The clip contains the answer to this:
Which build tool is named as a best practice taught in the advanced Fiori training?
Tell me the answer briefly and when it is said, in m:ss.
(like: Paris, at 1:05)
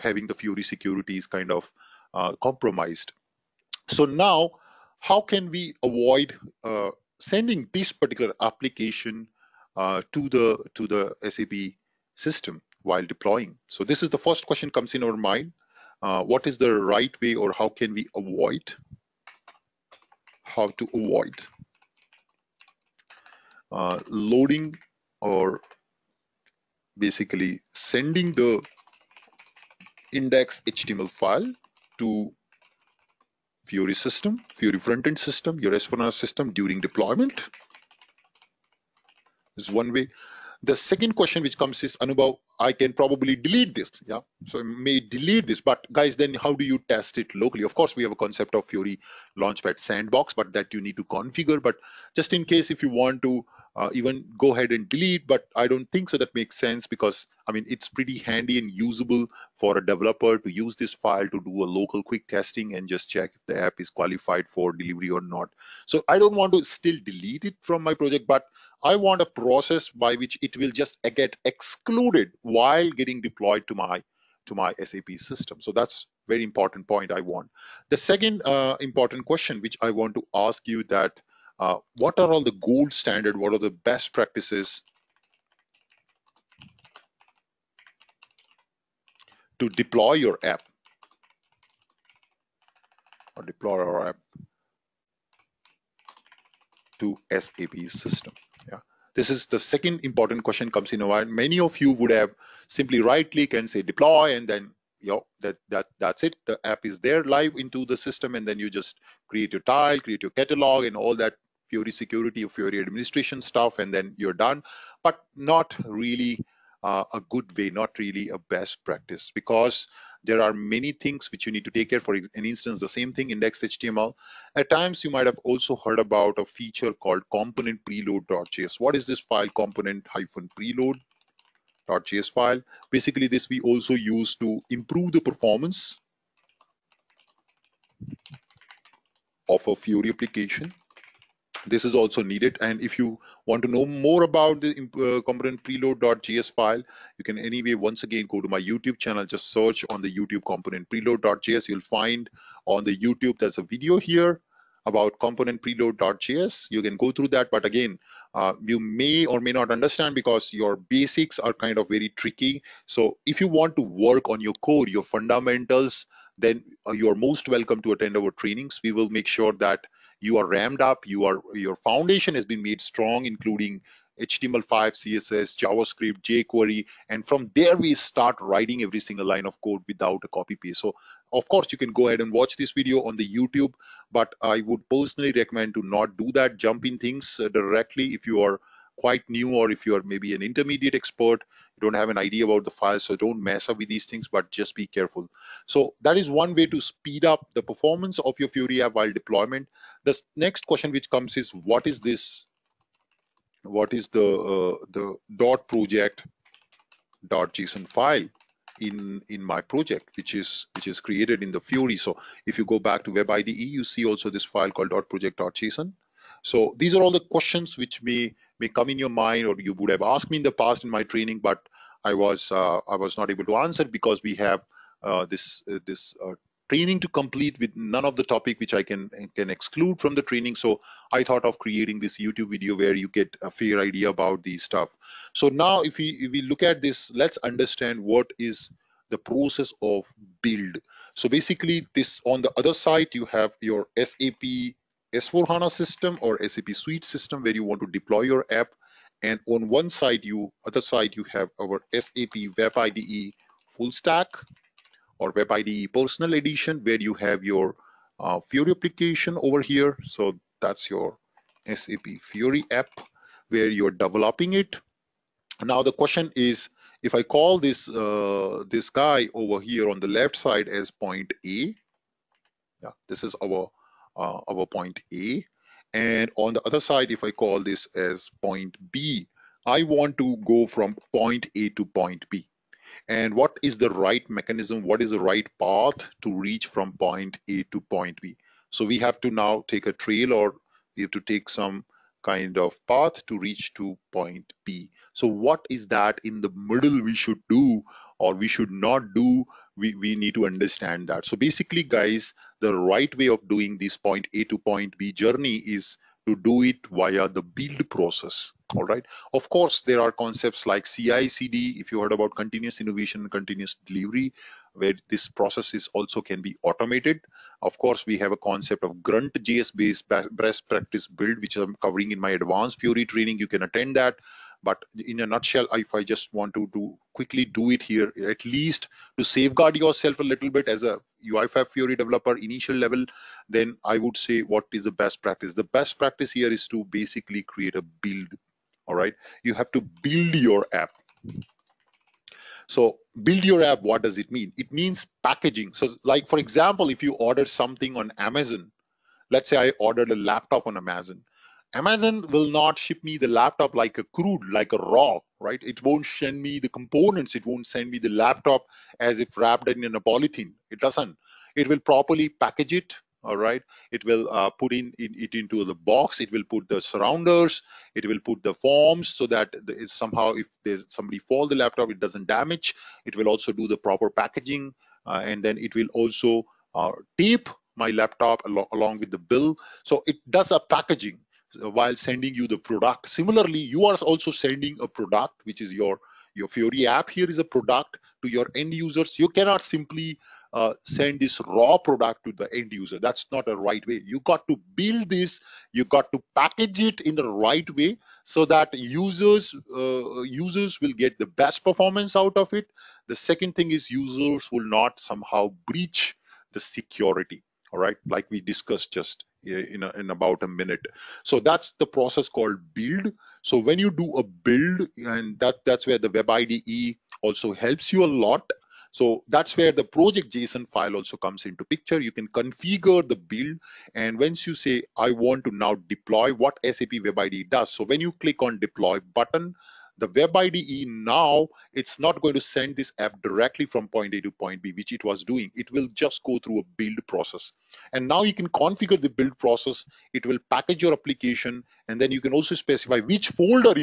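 Grunt JS, at 5:19.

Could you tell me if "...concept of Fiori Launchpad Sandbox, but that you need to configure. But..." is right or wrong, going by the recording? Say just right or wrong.
right.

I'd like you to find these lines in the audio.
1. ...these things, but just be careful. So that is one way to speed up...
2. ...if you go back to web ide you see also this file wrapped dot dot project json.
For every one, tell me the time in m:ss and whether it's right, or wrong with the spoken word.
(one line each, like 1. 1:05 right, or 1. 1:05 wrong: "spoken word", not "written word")
1. 3:13 right
2. 3:32 wrong: "called", not "wrapped".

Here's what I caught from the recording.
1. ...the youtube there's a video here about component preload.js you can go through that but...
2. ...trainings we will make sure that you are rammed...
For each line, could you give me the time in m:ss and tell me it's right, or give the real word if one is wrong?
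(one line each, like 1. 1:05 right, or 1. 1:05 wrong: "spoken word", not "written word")
1. 2:32 right
2. 2:48 right.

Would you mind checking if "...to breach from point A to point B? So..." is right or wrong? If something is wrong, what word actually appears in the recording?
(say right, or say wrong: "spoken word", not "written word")
wrong: "reach", not "breach".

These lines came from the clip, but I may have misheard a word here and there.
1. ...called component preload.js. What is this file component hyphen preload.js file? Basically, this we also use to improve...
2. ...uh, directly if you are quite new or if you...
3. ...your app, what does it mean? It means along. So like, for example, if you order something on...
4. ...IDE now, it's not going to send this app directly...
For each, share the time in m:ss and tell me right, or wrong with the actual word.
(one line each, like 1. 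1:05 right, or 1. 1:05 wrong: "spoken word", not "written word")
1. 2:06 right
2. 3:07 right
3. 5:43 wrong: "packaging", not "along"
4. 7:10 right.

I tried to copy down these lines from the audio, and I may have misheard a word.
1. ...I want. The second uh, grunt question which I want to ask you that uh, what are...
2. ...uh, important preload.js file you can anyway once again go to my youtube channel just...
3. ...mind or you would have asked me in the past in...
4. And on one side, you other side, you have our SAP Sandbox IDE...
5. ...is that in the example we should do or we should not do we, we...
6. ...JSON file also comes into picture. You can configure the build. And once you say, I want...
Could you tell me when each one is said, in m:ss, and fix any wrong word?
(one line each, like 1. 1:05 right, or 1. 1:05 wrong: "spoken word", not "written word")
1. 1:17 wrong: "important", not "grunt"
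2. 2:24 wrong: "component", not "important"
3. 3:39 right
4. 4:09 wrong: "Web", not "Sandbox"
5. 4:55 wrong: "middle", not "example"
6. 7:00 right.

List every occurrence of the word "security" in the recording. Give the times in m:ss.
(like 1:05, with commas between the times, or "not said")
0:00, 1:51, 6:46.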